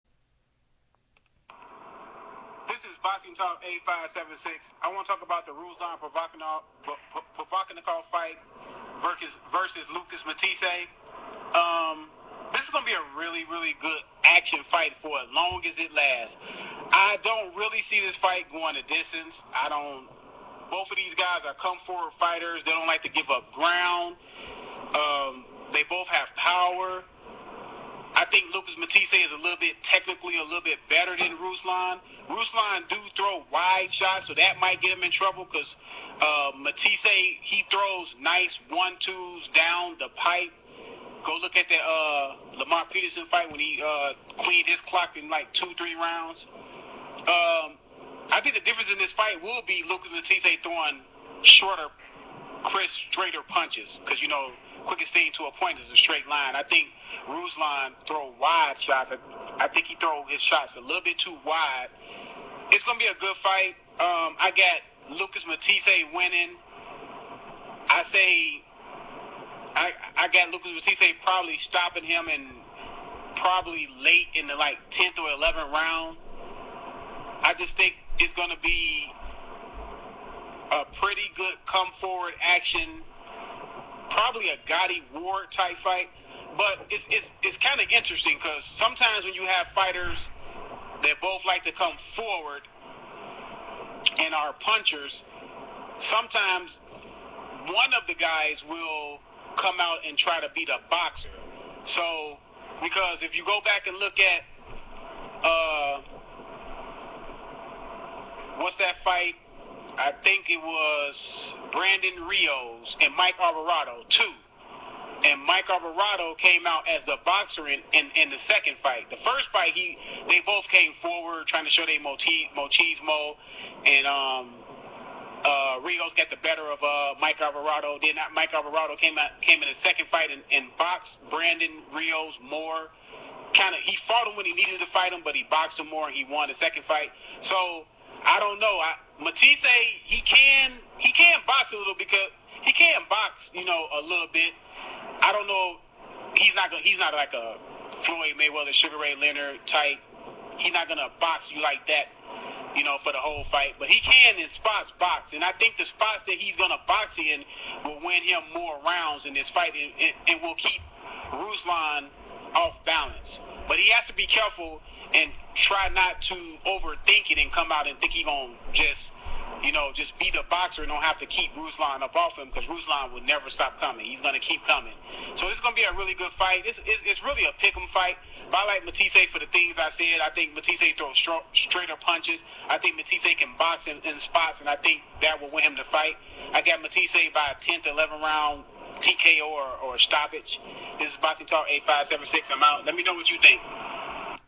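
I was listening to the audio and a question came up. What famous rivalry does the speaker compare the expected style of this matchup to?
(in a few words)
Gatti Ward.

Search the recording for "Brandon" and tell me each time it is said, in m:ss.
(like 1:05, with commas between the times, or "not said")
1:51, 2:11.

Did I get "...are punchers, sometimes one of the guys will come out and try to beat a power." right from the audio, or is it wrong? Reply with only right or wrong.
wrong.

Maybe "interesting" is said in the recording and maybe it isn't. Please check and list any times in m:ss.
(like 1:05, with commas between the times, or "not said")
1:27.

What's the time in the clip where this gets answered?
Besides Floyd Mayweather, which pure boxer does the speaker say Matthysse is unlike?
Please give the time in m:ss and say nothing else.
2:28.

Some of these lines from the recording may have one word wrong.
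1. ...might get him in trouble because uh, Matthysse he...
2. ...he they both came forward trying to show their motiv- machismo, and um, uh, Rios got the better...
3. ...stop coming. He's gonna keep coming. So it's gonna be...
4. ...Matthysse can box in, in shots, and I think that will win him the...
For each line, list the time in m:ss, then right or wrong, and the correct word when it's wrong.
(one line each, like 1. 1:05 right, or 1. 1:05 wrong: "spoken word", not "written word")
1. 0:34 right
2. 1:59 right
3. 2:53 right
4. 3:02 wrong: "spots", not "shots".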